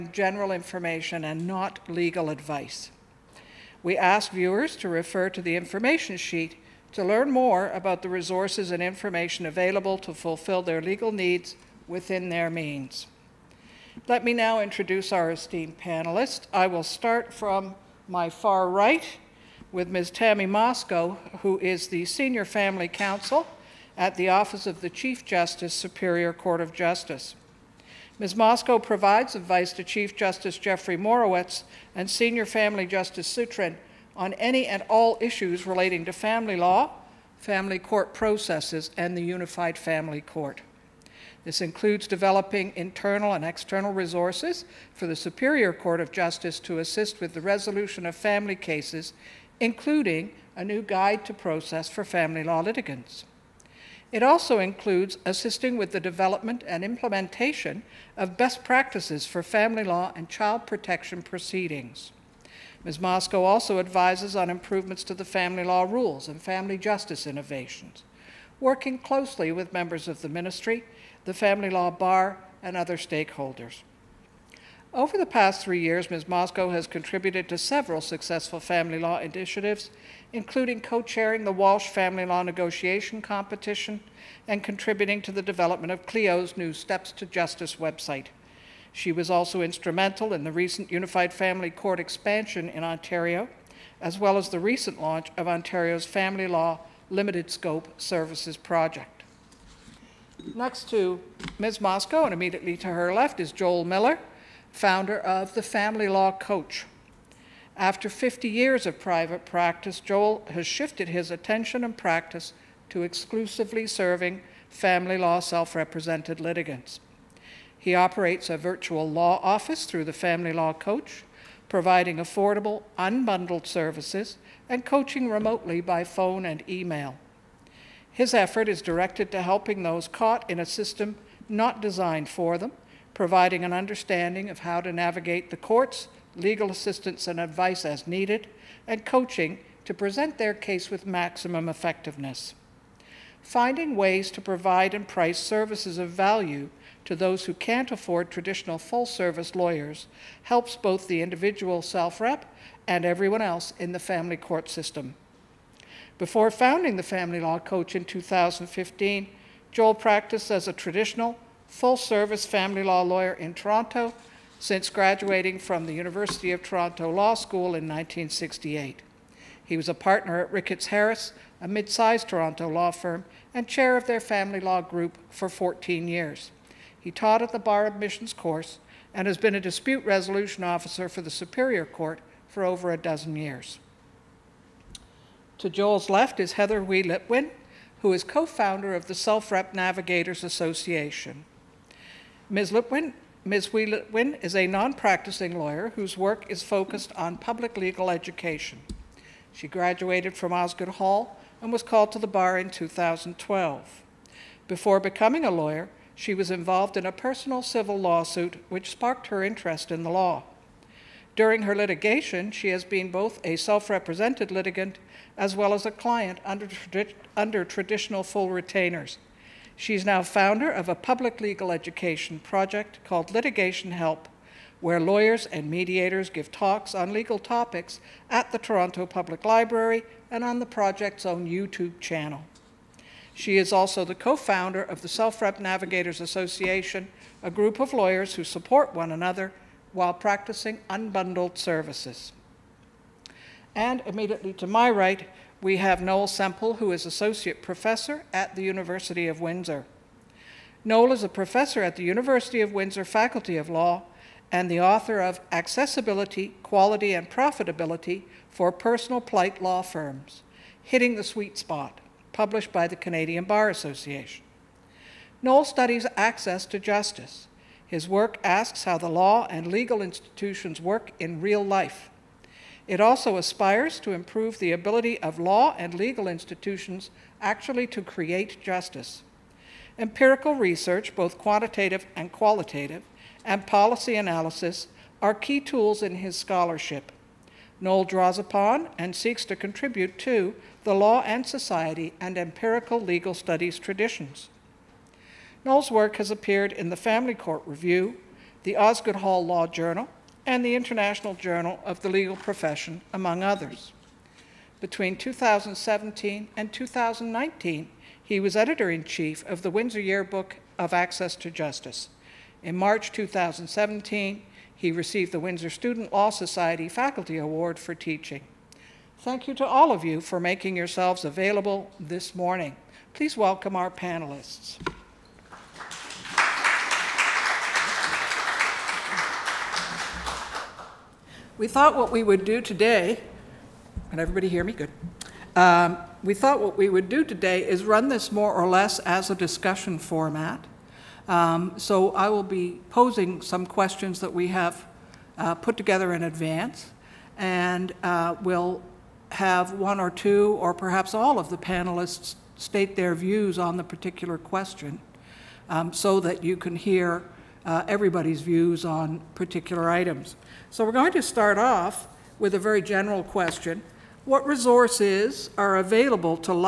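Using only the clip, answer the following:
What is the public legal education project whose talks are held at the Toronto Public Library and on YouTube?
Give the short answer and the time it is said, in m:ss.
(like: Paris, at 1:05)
Litigation Help, at 3:43.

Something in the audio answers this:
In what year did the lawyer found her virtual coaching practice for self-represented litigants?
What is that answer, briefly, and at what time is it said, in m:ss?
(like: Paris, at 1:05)
2015, at 2:38.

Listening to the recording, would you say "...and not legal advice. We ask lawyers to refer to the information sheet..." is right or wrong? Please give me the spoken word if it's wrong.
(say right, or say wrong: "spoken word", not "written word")
wrong: "viewers", not "lawyers".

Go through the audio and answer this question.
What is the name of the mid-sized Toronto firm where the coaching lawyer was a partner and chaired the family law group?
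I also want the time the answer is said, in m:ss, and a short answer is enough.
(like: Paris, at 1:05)
Ricketts Harris, at 2:50.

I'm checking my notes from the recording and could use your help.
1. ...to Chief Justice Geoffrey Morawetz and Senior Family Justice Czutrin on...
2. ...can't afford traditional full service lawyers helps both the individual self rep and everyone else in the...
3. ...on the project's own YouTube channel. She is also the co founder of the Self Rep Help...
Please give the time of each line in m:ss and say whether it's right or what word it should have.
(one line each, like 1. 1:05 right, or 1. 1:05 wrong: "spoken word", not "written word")
1. 0:29 right
2. 2:27 right
3. 3:50 wrong: "Navigators", not "Help".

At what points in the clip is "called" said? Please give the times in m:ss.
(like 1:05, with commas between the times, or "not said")
3:21, 3:43.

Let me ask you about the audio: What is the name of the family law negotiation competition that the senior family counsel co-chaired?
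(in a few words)
Walsh.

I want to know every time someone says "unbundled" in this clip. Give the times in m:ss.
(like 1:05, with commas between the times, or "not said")
2:02, 4:00.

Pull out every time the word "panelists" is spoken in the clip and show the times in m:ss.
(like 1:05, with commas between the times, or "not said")
0:15, 5:23, 5:51.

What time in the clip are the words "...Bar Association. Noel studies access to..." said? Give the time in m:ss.
4:23.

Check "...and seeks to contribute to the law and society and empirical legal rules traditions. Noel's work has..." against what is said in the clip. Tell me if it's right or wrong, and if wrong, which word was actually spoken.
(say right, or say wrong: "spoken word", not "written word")
wrong: "studies", not "rules".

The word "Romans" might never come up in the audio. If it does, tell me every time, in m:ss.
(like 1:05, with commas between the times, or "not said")
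not said.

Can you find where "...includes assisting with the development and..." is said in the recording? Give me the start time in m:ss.
0:54.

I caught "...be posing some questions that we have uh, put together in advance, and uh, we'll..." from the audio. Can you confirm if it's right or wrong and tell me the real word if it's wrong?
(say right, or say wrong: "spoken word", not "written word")
right.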